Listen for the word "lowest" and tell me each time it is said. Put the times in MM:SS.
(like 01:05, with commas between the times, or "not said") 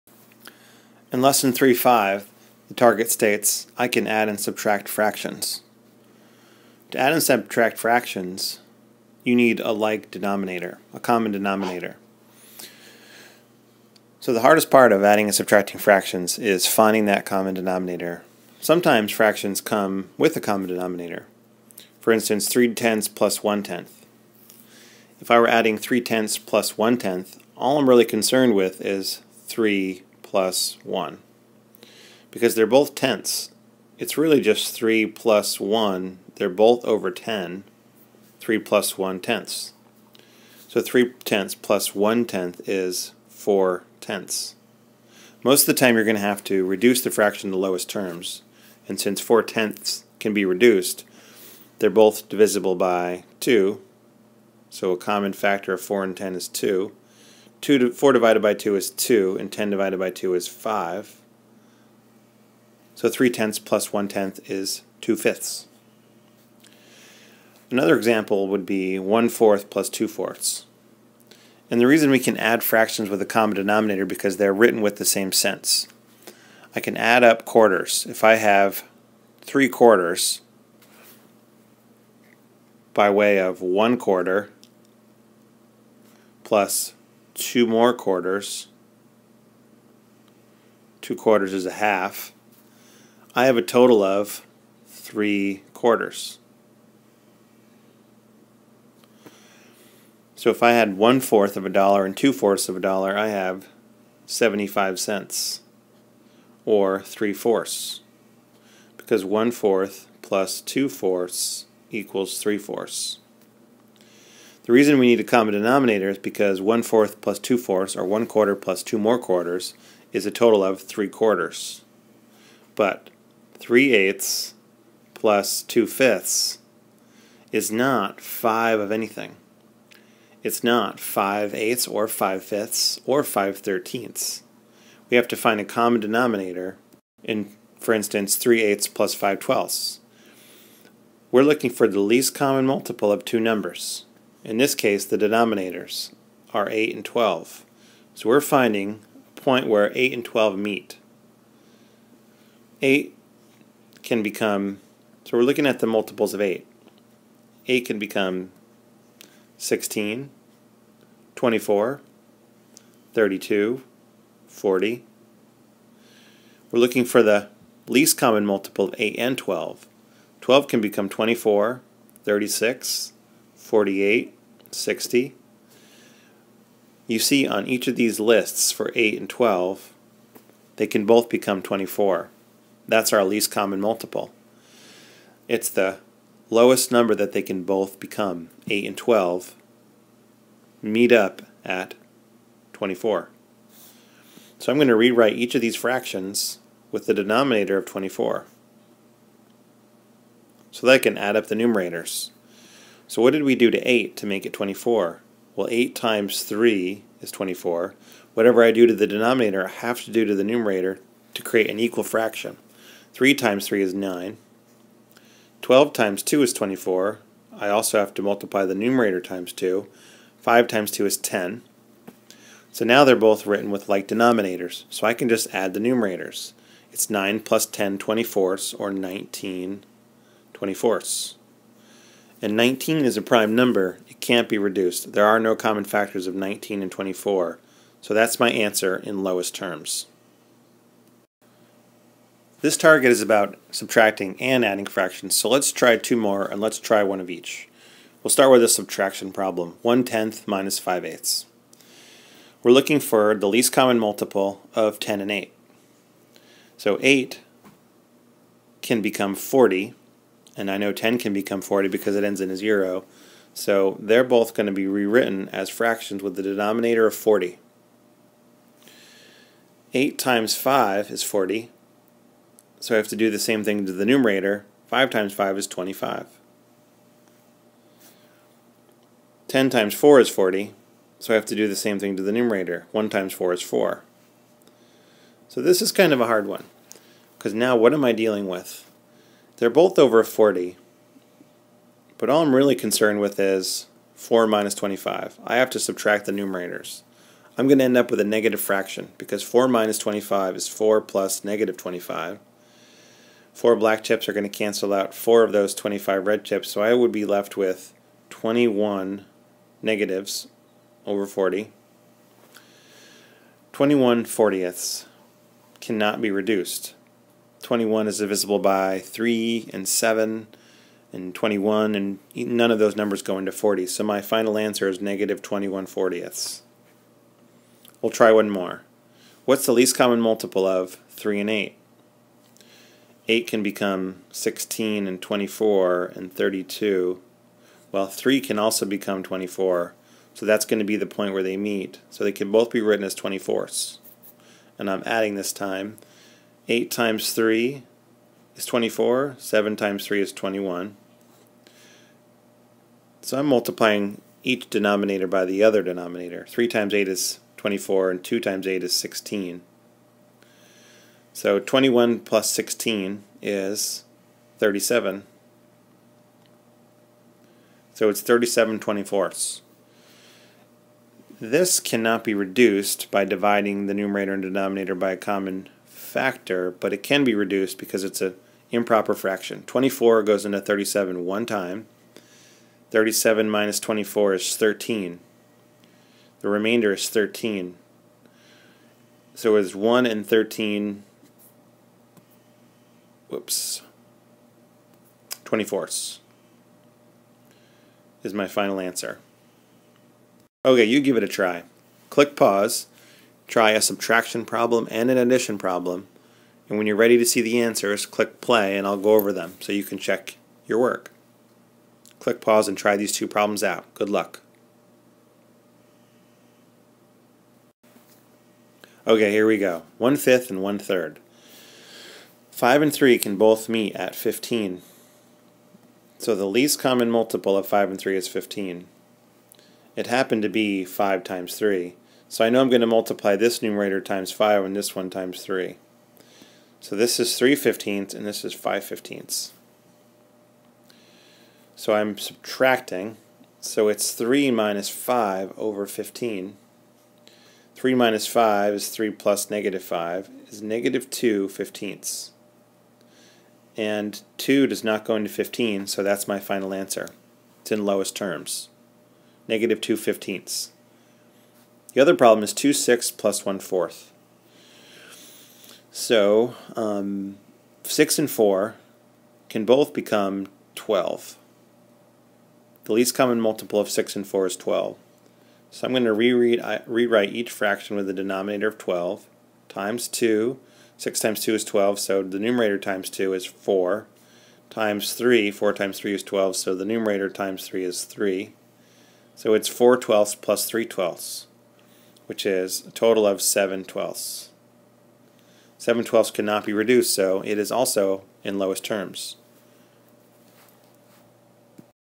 00:47, 03:06, 03:59, 07:37, 08:18.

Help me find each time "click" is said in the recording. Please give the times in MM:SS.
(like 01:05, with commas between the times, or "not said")
06:42, 06:48, 06:52.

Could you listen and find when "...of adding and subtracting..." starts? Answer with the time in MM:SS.
00:14.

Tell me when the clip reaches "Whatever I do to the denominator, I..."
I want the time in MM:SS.
03:28.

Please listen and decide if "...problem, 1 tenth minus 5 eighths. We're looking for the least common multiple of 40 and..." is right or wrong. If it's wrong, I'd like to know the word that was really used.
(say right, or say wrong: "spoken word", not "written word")
wrong: "10", not "40".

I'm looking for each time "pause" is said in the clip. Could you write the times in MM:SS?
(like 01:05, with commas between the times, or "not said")
06:42, 06:52.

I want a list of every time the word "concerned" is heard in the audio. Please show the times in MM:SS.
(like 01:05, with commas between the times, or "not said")
00:28, 04:52.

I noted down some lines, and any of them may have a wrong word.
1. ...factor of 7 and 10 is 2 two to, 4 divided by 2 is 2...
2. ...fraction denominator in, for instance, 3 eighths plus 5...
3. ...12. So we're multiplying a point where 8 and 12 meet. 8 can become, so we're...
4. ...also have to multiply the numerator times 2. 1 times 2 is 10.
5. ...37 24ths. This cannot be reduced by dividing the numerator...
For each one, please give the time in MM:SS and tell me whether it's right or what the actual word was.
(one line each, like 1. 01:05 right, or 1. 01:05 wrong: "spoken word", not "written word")
1. 00:55 wrong: "4", not "7"
2. 02:15 wrong: "common", not "fraction"
3. 02:27 wrong: "finding", not "multiplying"
4. 03:37 wrong: "5", not "1"
5. 06:08 right.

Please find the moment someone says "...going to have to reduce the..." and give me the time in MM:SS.
00:46.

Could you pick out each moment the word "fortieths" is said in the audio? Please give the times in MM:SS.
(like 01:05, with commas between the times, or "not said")
05:14, 05:25.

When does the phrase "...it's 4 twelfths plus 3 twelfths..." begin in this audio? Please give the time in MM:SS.
08:09.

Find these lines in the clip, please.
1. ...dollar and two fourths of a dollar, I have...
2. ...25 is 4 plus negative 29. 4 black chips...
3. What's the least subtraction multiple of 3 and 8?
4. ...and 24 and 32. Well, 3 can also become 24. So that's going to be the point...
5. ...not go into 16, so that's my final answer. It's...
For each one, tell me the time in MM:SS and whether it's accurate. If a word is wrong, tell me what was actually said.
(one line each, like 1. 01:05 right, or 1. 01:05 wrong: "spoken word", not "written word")
1. 01:41 right
2. 04:59 wrong: "25", not "29"
3. 05:29 wrong: "common", not "subtraction"
4. 05:35 right
5. 07:34 wrong: "15", not "16".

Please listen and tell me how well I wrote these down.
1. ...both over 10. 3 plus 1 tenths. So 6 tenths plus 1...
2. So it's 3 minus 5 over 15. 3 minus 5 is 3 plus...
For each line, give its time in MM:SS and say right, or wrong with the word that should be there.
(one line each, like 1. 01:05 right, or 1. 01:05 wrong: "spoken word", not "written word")
1. 00:36 wrong: "3", not "6"
2. 07:23 right.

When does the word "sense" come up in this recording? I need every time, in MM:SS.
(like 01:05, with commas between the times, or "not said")
01:15.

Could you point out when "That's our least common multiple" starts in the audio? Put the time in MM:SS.
03:02.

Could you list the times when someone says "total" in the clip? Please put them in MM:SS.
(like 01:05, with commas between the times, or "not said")
01:33, 02:00, 08:12.